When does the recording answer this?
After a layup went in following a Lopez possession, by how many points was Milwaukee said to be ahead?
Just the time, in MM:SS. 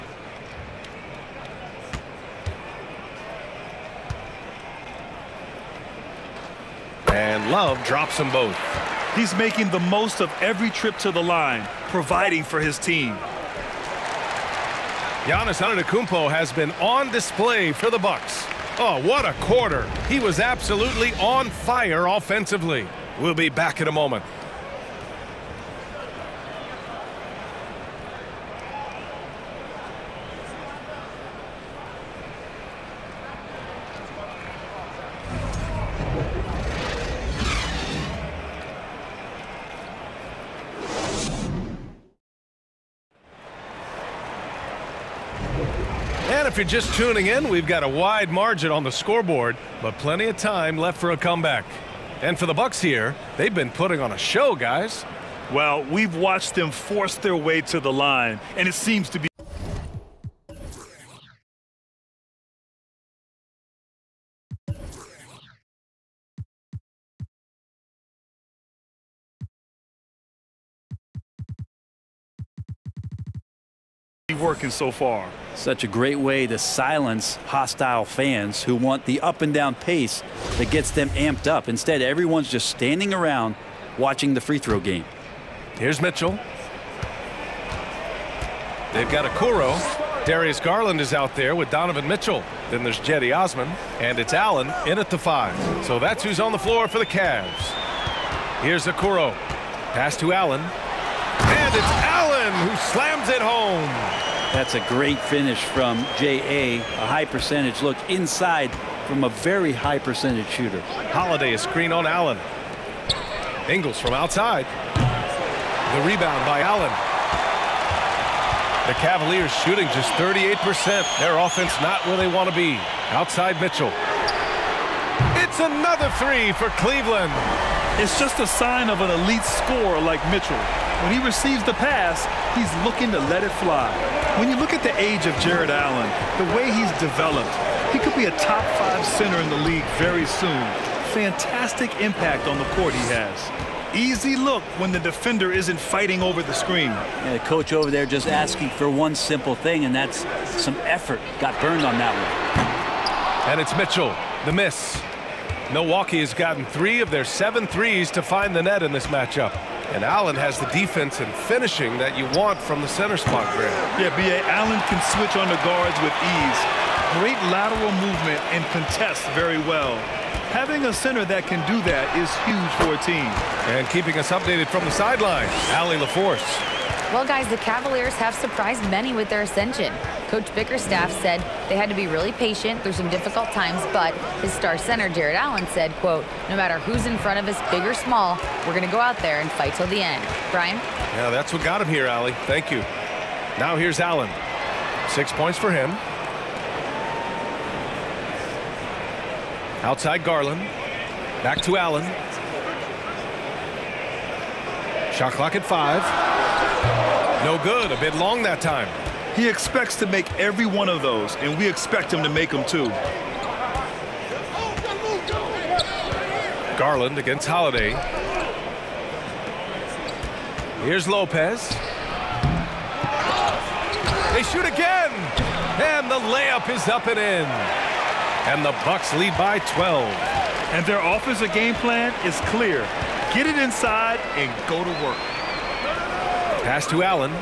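03:49.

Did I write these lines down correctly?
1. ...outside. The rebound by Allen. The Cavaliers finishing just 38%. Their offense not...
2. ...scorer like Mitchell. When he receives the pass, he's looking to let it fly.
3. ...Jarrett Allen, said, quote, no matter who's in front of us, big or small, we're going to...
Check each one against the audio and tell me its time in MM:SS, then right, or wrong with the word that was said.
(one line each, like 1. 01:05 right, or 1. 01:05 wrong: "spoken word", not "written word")
1. 01:54 wrong: "shooting", not "finishing"
2. 02:09 right
3. 03:05 right.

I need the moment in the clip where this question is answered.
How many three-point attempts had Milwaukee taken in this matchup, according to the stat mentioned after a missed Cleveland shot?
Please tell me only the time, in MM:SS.
02:37.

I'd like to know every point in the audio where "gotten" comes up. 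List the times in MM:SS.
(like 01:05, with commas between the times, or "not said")
02:36.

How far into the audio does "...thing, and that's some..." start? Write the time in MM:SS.
02:29.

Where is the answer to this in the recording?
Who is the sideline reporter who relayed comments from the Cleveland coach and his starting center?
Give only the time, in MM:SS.
02:55.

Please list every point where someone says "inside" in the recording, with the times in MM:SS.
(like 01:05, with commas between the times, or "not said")
01:48, 03:53.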